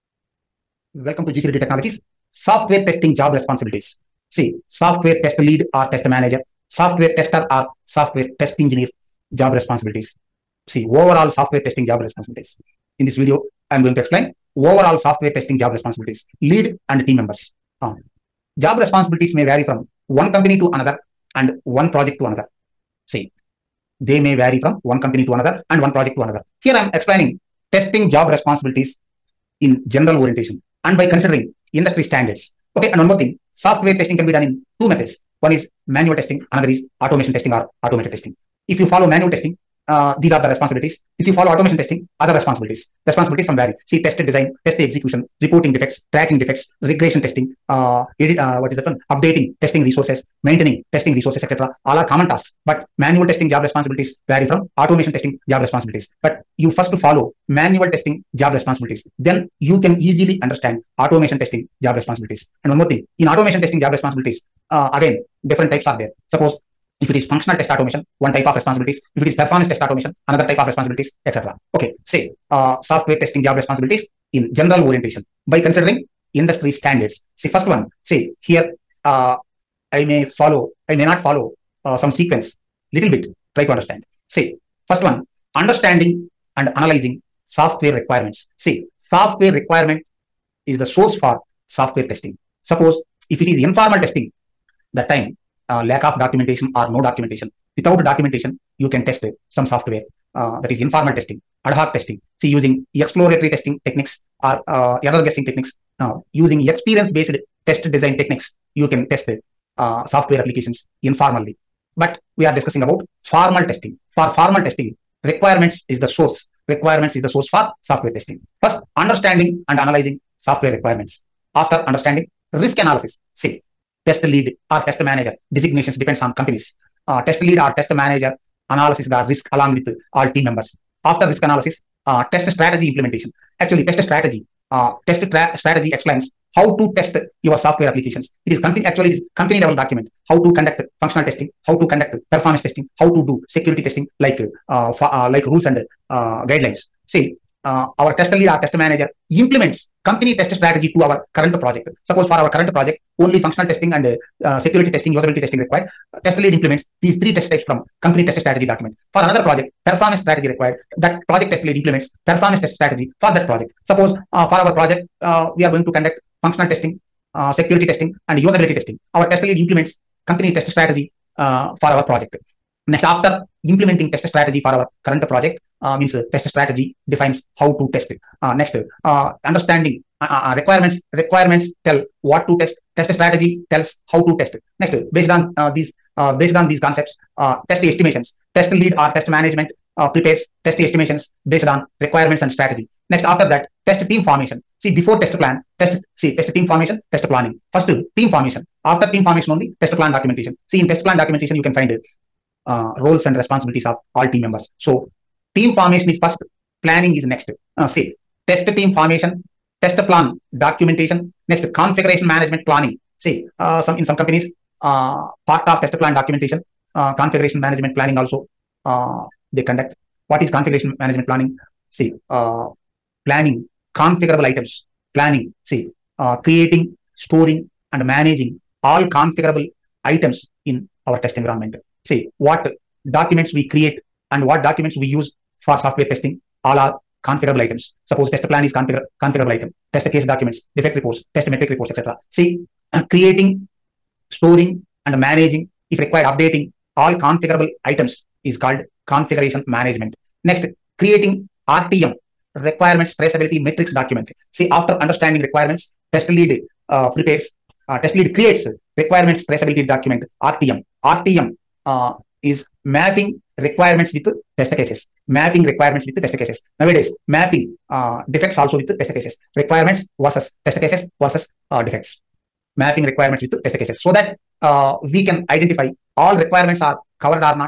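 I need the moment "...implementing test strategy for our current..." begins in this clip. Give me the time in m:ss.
2:53.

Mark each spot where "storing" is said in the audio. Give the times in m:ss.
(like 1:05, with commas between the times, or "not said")
3:47, 4:04.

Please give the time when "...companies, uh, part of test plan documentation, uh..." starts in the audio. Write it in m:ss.
3:34.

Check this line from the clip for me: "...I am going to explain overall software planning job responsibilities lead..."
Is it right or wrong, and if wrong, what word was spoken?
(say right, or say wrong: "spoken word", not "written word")
wrong: "testing", not "planning".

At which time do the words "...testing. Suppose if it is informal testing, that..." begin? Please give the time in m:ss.
1:32.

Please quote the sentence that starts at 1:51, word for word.
But we are discussing about formal testing.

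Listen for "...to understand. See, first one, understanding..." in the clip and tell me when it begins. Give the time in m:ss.
1:23.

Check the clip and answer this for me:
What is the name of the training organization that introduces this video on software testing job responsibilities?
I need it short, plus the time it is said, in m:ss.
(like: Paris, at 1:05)
G C Reddy Technologies, at 0:01.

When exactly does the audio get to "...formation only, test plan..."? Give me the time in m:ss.
3:19.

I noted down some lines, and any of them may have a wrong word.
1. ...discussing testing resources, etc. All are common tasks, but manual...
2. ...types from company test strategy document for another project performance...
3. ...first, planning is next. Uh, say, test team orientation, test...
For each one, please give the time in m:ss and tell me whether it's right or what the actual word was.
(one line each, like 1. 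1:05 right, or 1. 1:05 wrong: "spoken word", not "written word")
1. 0:50 wrong: "maintaining", not "discussing"
2. 2:37 right
3. 3:26 wrong: "formation", not "orientation".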